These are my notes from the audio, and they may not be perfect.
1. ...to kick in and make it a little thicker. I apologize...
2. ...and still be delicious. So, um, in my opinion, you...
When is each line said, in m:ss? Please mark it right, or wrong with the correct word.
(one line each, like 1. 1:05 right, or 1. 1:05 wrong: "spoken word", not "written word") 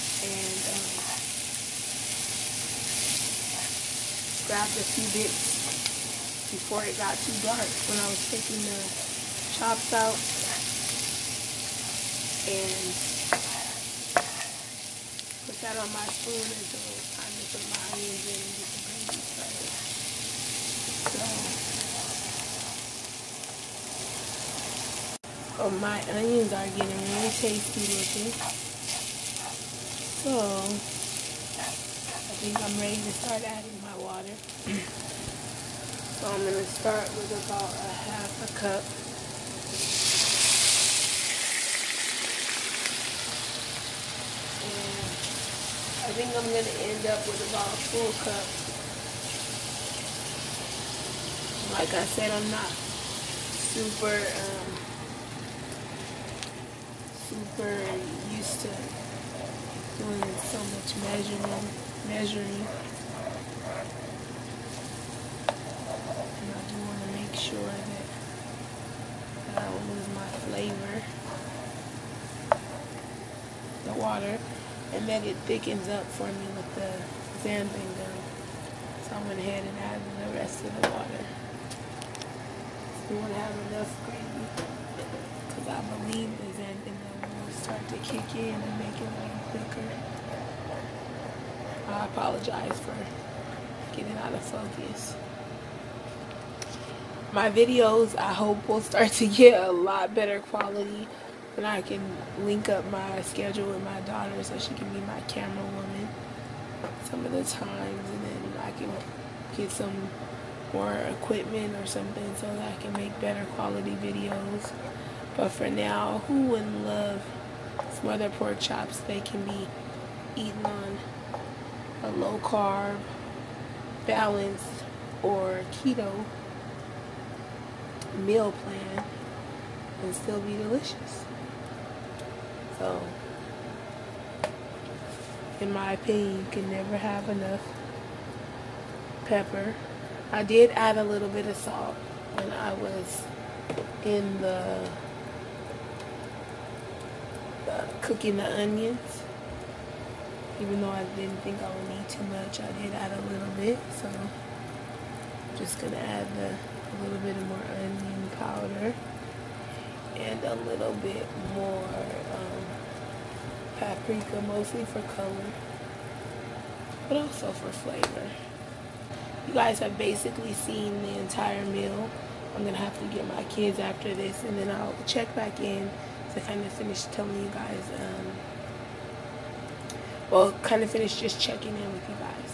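1. 1:27 right
2. 2:10 right.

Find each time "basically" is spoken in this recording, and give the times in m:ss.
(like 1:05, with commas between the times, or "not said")
2:49.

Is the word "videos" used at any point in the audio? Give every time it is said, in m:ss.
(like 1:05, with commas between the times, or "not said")
1:37, 1:54.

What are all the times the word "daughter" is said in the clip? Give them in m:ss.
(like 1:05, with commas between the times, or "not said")
1:44.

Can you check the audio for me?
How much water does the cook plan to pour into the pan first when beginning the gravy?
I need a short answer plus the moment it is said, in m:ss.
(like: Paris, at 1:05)
half a cup, at 0:37.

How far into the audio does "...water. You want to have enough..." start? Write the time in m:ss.
1:20.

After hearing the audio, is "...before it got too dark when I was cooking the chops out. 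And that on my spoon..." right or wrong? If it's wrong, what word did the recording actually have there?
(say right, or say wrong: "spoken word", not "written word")
wrong: "taking", not "cooking".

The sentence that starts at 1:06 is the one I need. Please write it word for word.
And I do want to make sure that, that I don't lose my flavor.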